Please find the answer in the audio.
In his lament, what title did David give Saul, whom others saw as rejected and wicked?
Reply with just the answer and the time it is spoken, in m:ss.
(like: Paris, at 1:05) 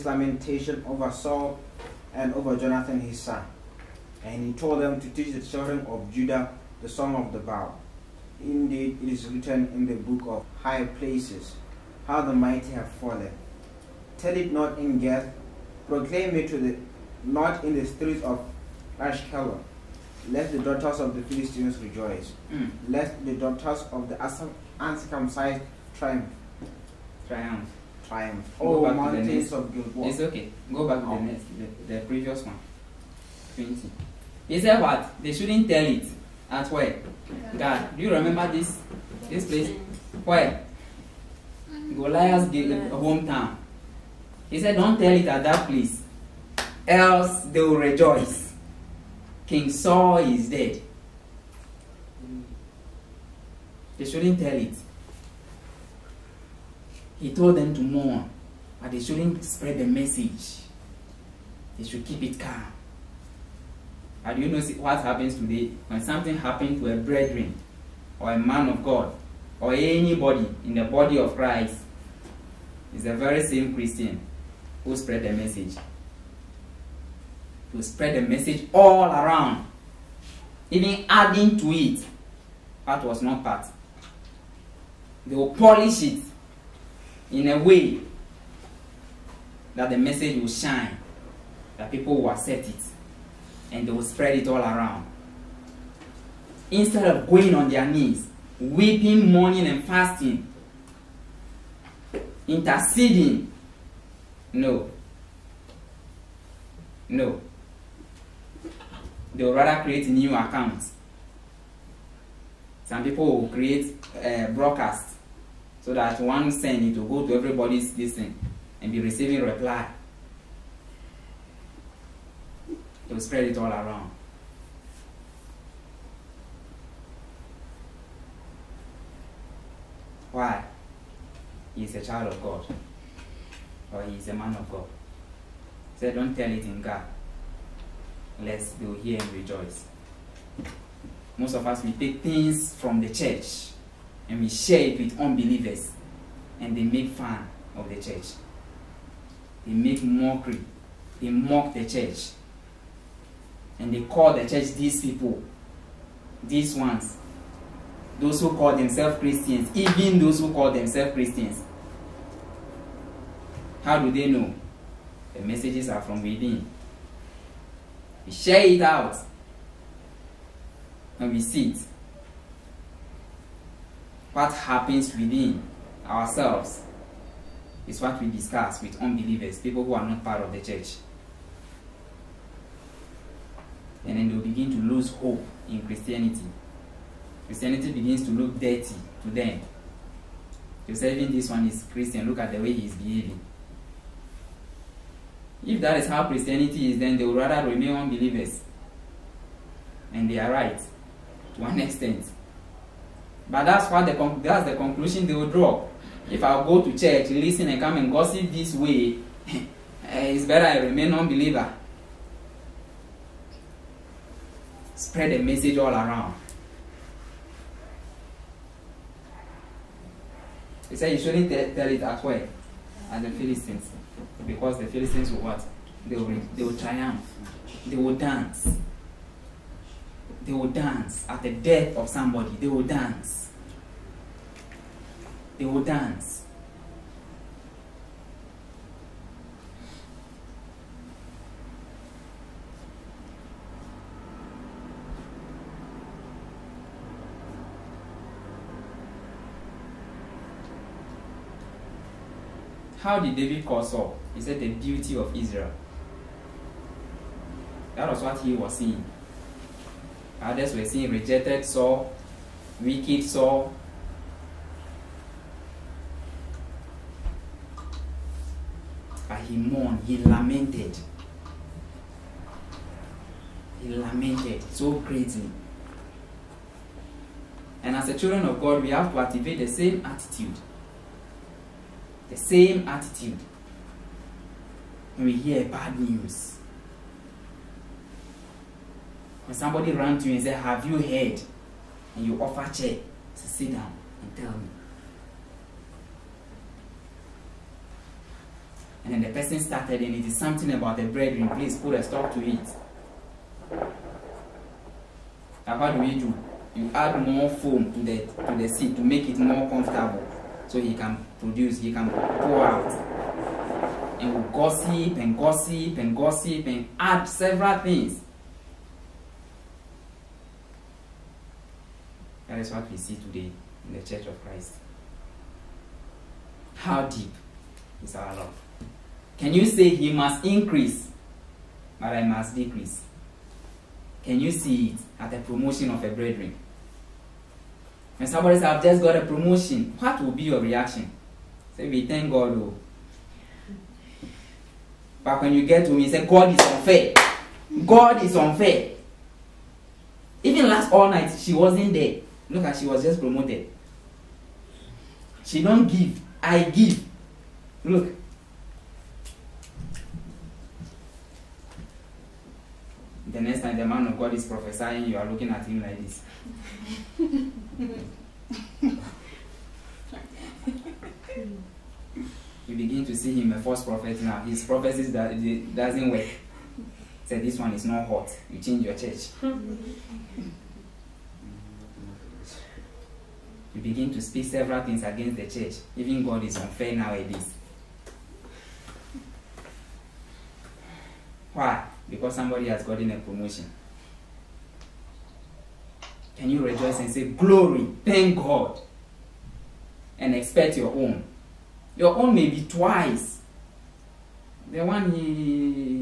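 The beauty of Israel, at 4:14.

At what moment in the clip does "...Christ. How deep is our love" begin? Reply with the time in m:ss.
5:24.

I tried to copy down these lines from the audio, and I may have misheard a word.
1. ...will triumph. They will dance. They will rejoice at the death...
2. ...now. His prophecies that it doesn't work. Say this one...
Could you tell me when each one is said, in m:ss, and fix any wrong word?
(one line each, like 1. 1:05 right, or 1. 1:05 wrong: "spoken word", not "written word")
1. 3:46 wrong: "dance", not "rejoice"
2. 6:14 right.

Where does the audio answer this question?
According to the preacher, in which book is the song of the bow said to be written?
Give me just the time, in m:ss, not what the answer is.
0:09.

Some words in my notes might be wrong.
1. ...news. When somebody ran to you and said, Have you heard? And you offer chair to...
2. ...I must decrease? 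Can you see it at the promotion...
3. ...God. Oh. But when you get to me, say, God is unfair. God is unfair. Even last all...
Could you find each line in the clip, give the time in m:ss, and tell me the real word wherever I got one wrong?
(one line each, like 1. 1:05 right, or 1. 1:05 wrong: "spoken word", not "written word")
1. 4:45 right
2. 5:32 right
3. 5:42 right.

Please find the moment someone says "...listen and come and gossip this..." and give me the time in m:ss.
3:27.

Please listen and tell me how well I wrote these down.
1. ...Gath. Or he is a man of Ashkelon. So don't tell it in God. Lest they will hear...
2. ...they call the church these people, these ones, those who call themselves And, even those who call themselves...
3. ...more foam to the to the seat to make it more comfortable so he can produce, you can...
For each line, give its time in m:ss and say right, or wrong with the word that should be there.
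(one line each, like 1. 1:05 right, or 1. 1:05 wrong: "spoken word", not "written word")
1. 2:12 wrong: "God", not "Ashkelon"
2. 2:33 wrong: "Christians", not "And"
3. 5:07 right.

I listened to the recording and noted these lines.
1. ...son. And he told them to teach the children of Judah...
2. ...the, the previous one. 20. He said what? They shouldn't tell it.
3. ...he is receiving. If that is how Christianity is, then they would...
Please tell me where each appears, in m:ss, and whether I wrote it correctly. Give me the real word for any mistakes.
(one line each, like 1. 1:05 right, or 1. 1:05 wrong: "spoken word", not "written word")
1. 0:03 right
2. 0:31 right
3. 3:12 wrong: "behaving", not "receiving".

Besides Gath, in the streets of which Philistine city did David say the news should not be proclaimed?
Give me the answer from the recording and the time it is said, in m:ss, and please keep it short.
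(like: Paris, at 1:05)
Ashkelon, at 0:18.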